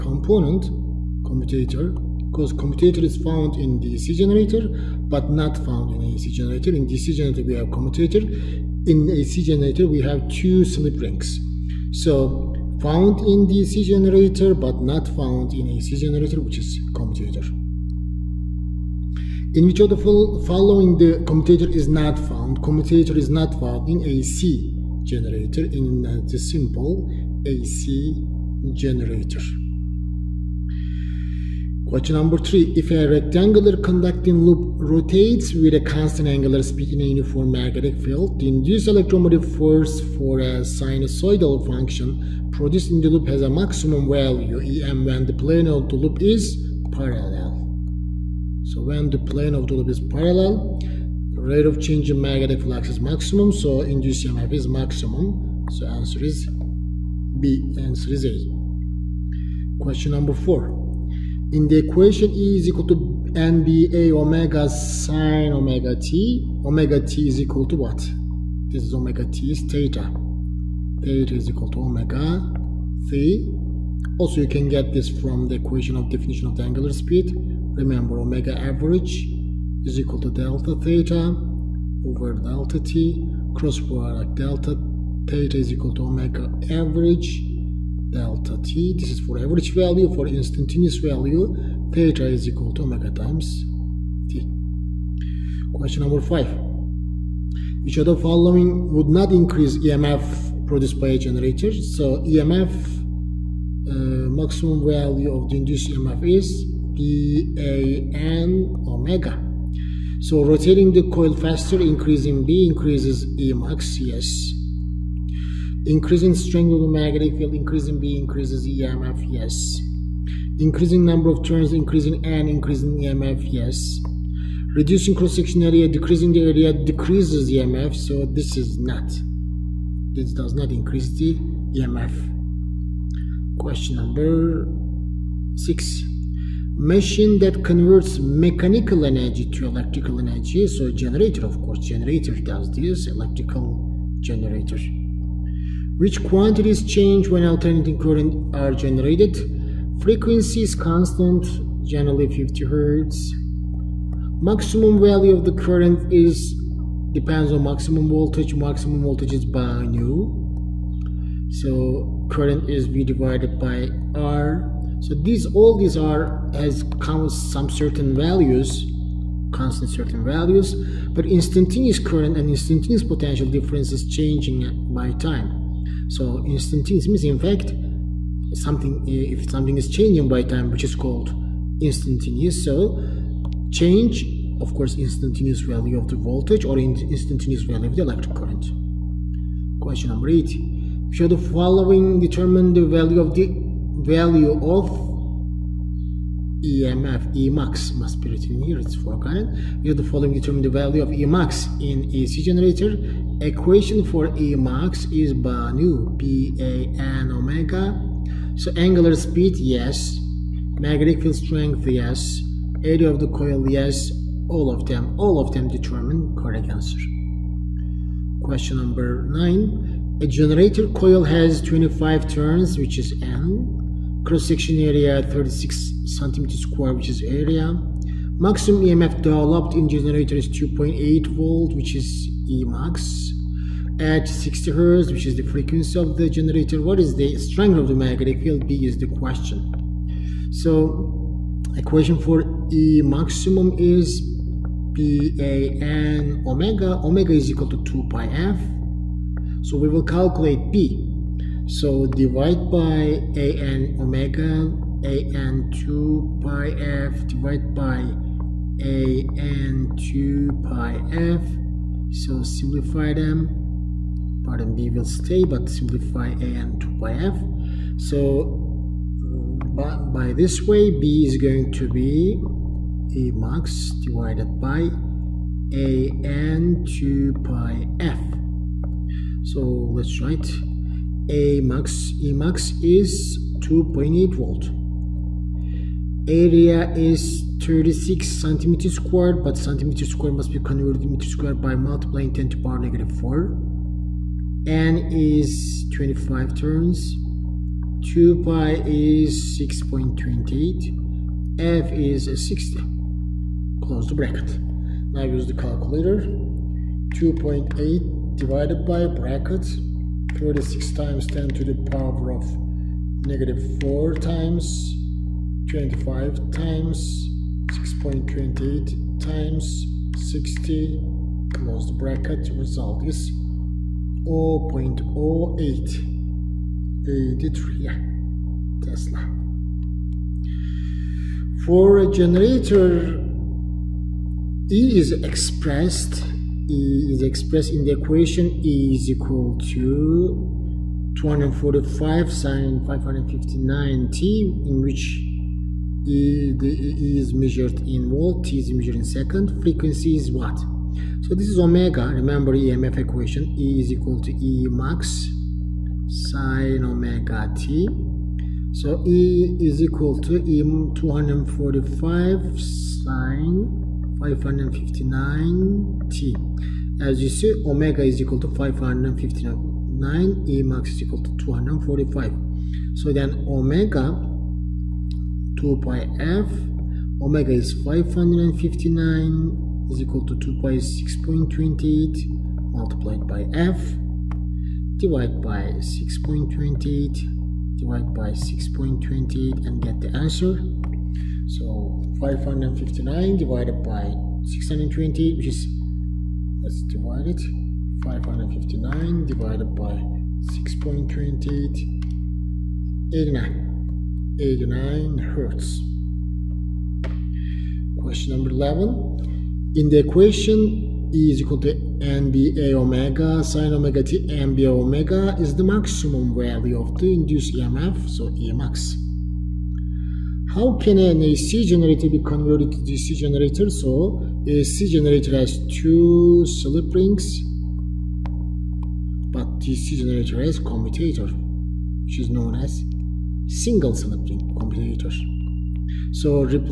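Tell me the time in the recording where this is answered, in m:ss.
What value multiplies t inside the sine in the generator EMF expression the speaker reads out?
5:42.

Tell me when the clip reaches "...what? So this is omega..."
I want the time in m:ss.
5:50.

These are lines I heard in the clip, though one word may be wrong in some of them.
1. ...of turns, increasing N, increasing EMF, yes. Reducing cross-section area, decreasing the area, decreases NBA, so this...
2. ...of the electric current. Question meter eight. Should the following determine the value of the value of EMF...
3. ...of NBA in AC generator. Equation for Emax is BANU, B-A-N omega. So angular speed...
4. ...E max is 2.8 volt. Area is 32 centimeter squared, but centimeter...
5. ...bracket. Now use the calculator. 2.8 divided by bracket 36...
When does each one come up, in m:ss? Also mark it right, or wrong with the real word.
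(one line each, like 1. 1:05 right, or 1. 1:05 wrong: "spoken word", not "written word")
1. 2:01 wrong: "EMF", not "NBA"
2. 3:07 wrong: "number", not "meter"
3. 3:21 wrong: "Emax", not "NBA"
4. 4:42 wrong: "36", not "32"
5. 5:04 right.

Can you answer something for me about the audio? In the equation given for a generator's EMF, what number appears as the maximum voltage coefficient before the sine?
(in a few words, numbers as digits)
245.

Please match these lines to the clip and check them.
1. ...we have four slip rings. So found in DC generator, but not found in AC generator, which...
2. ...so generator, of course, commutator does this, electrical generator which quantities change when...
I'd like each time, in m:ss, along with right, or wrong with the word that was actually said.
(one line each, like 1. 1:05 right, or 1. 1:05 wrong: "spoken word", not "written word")
1. 0:09 wrong: "two", not "four"
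2. 2:20 wrong: "generator", not "commutator".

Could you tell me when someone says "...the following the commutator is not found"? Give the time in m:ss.
0:19.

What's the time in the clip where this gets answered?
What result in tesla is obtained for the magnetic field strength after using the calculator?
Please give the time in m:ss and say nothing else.
5:24.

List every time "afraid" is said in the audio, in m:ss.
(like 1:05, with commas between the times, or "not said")
not said.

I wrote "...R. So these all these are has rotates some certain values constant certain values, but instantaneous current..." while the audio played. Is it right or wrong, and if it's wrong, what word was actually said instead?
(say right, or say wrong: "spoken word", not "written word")
wrong: "comes", not "rotates".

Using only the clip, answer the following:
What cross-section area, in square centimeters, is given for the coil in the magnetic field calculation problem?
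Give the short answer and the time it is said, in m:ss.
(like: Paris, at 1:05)
36 square centimeters, at 3:45.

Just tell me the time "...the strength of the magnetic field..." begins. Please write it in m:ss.
3:57.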